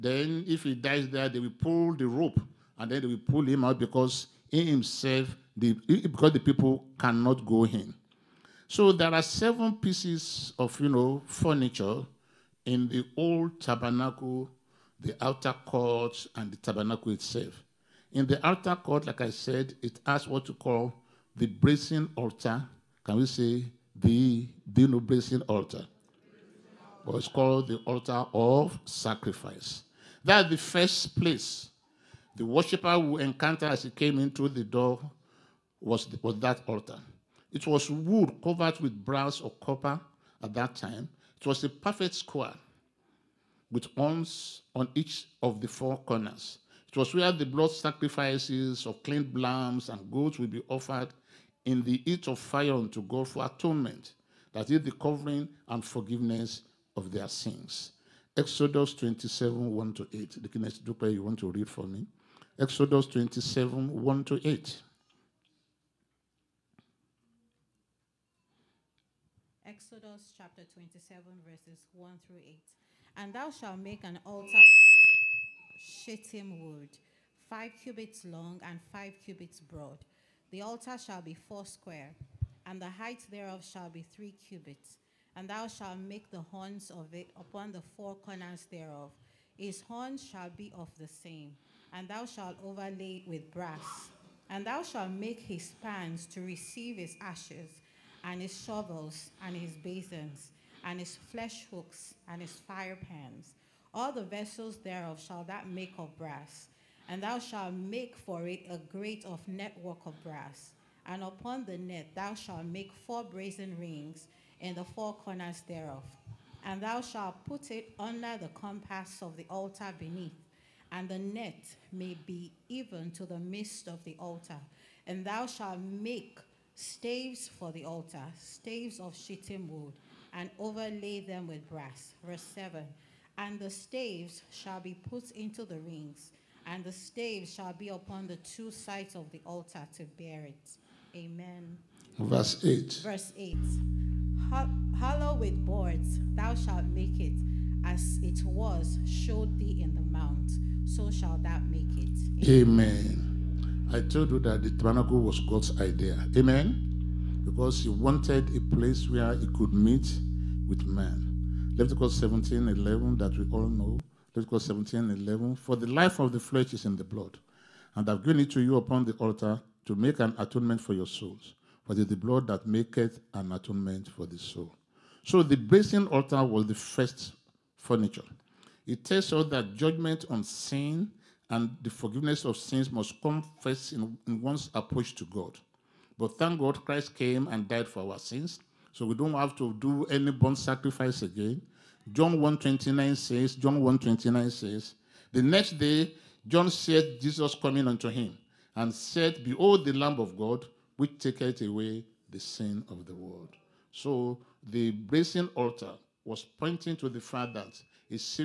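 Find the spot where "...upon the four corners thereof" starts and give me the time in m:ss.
1:27.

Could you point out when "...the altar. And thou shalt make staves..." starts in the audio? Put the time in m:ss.
2:04.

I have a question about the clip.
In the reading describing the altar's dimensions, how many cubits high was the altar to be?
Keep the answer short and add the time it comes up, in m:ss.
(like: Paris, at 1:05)
3, at 1:24.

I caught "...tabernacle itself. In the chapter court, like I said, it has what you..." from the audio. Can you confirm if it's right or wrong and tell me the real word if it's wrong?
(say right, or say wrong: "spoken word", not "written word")
wrong: "outer", not "chapter".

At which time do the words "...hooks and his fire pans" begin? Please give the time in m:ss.
1:41.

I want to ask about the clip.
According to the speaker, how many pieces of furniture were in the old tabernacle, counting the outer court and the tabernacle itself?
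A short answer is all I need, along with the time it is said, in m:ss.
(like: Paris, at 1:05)
7, at 0:09.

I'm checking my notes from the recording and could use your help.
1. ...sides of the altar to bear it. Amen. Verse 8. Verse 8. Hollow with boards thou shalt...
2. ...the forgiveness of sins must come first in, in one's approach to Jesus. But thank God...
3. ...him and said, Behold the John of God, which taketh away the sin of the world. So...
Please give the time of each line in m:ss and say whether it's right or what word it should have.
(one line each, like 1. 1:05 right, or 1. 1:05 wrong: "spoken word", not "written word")
1. 2:18 right
2. 3:01 wrong: "God", not "Jesus"
3. 3:18 wrong: "Lamb", not "John".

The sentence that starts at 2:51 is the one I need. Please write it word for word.
For it is the blood that maketh an atonement for the soul.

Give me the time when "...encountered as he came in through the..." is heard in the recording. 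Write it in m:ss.
0:33.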